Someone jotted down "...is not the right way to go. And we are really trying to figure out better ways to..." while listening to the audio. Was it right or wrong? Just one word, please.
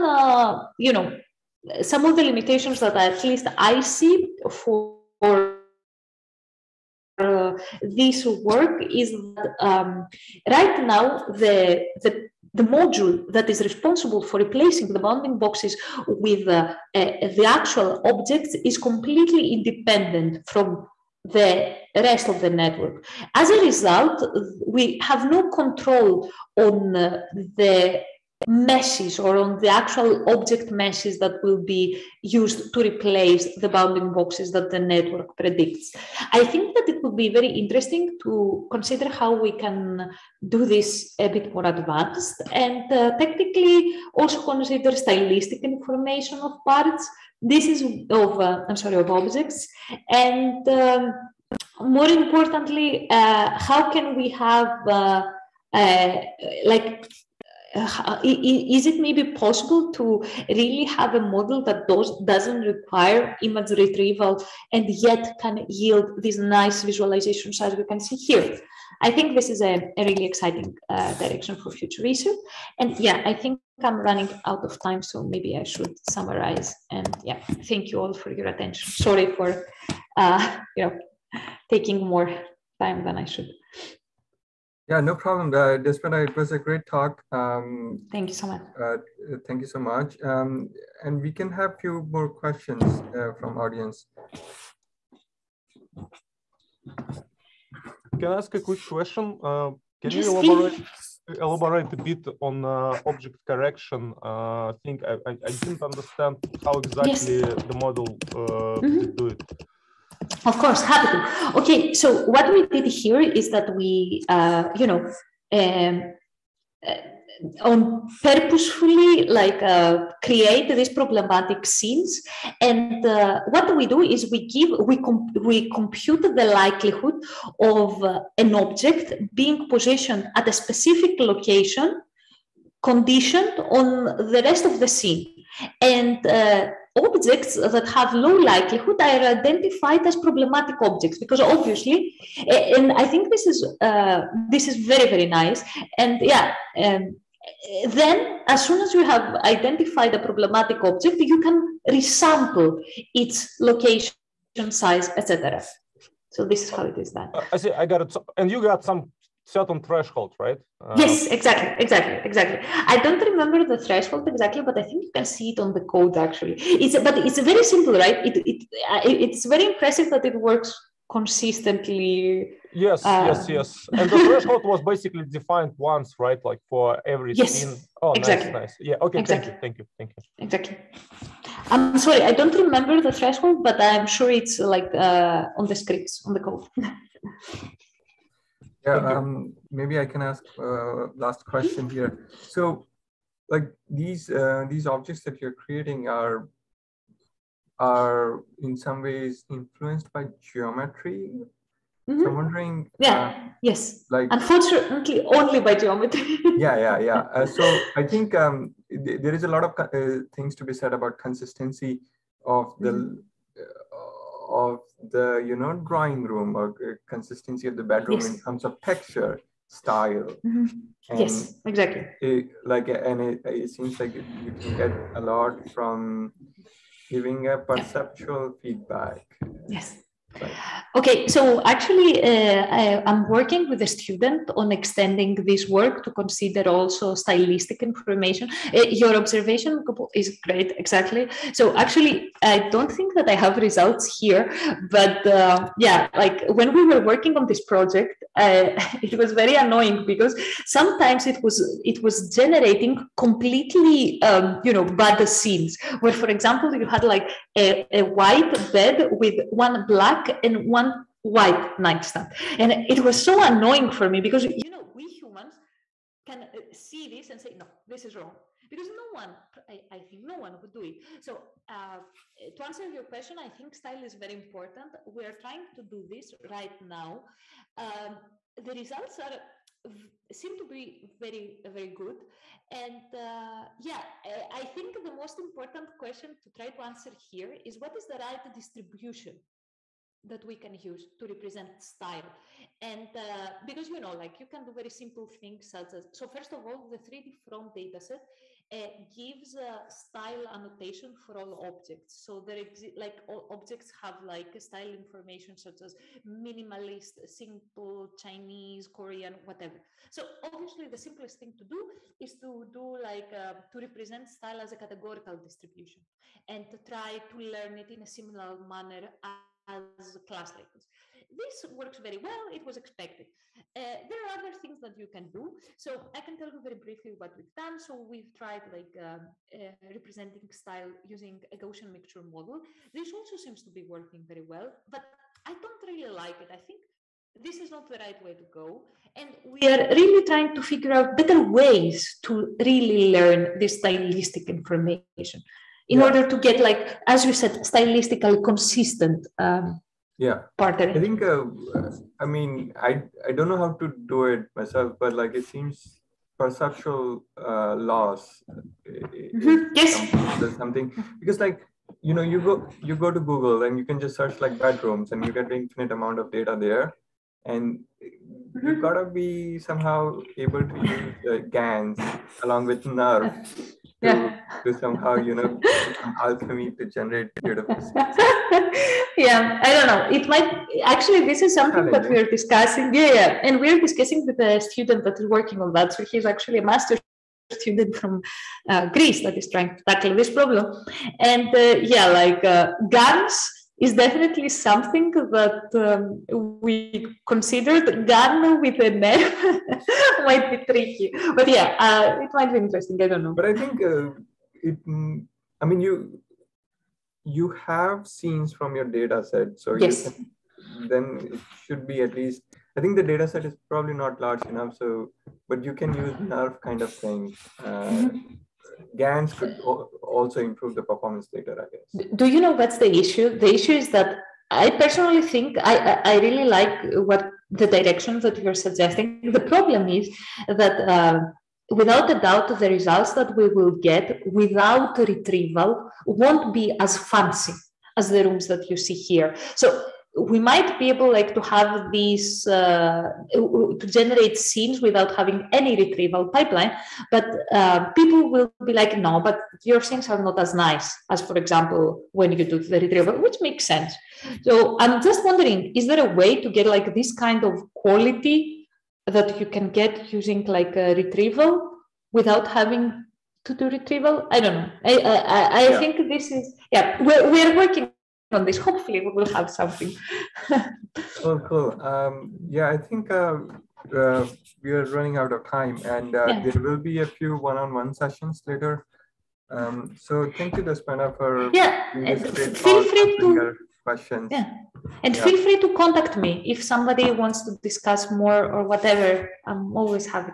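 right.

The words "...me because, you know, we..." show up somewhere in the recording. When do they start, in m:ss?
4:24.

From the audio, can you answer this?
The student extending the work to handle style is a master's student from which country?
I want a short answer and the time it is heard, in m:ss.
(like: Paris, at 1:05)
Greece, at 6:28.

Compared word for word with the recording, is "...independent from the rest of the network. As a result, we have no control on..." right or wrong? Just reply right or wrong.
right.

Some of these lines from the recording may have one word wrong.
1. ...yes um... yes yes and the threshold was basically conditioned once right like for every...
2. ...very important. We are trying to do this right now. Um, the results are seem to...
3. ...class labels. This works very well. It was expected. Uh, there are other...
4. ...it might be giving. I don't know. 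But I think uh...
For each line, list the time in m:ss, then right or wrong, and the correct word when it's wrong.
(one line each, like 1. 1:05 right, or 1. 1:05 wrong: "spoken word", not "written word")
1. 2:52 wrong: "defined", not "conditioned"
2. 4:34 right
3. 5:20 right
4. 6:42 wrong: "interesting", not "giving".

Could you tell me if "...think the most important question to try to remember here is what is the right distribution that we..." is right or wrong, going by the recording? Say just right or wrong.
wrong.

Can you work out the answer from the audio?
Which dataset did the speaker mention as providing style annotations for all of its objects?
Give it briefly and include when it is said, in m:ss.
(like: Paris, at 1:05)
3D front, at 4:56.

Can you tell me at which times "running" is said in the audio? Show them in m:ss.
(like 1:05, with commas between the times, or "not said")
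1:14, 7:54.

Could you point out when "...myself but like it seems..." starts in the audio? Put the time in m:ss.
5:54.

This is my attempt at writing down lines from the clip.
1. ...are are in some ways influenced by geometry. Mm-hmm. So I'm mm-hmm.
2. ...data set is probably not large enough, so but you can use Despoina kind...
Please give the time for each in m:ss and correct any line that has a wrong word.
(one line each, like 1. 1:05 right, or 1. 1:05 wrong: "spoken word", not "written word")
1. 3:16 right
2. 6:53 wrong: "NeRF", not "Despoina".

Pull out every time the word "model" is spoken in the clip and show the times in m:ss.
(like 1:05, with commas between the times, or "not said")
1:01, 1:47, 5:32.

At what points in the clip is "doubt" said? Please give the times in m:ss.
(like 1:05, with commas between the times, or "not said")
7:12.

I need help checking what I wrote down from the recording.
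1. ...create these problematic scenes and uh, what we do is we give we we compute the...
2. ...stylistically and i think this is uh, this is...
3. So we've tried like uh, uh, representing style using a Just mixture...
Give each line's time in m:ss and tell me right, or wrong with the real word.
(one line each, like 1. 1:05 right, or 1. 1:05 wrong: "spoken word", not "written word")
1. 2:00 right
2. 2:21 wrong: "obviously", not "stylistically"
3. 5:27 wrong: "Gaussian", not "Just".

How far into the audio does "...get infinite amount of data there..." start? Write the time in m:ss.
6:05.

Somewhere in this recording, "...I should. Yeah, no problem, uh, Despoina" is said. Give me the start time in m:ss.
1:23.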